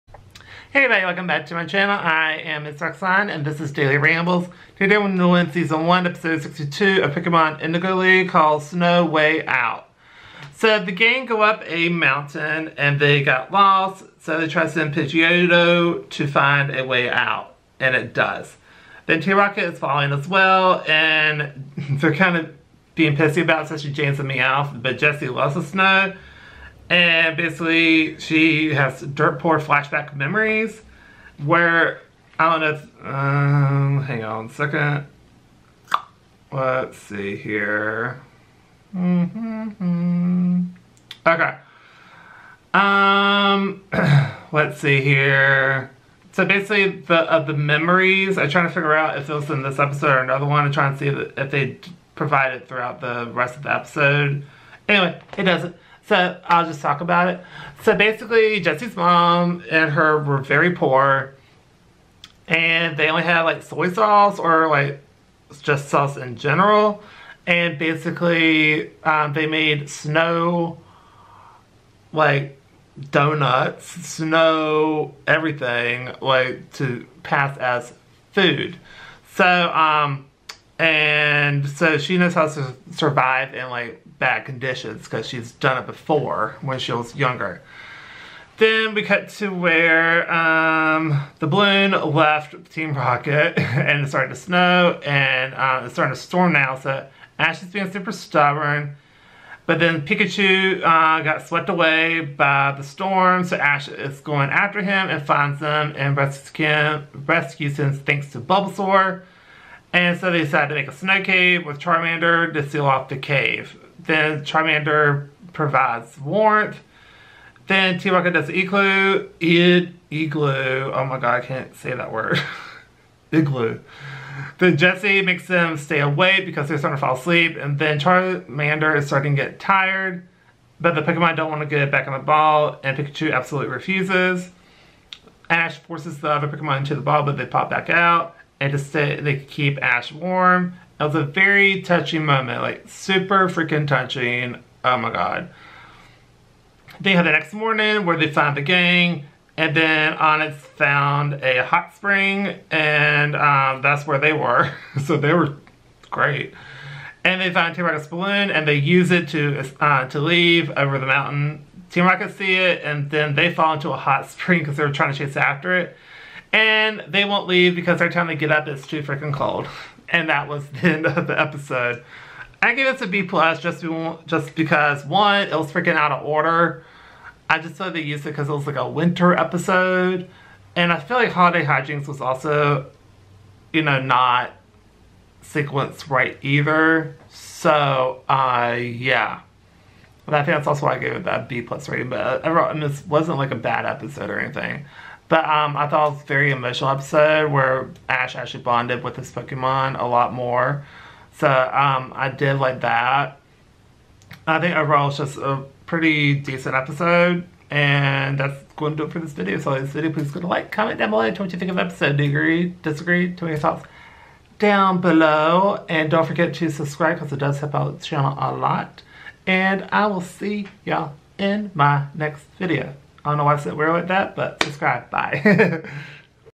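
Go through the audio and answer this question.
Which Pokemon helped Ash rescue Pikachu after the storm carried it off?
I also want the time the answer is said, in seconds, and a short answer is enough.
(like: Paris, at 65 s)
Bulbasaur, at 108 s.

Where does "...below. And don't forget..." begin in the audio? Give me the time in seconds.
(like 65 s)
214 s.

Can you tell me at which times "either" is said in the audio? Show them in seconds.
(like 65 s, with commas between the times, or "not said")
186 s.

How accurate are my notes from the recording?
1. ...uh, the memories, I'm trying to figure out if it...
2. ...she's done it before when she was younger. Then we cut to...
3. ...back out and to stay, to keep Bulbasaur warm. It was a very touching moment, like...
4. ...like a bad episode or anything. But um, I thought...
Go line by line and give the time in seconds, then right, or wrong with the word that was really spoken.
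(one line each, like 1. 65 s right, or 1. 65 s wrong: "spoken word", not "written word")
1. 47 s right
2. 85 s right
3. 137 s wrong: "Ash", not "Bulbasaur"
4. 193 s right.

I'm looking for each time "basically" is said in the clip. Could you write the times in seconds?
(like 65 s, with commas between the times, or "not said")
27 s, 46 s, 57 s, 67 s.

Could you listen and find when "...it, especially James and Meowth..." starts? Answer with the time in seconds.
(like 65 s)
23 s.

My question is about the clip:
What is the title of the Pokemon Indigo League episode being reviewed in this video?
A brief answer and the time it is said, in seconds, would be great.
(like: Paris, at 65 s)
Snow Way Out, at 8 s.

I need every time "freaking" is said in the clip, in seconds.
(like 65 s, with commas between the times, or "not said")
143 s, 169 s, 175 s.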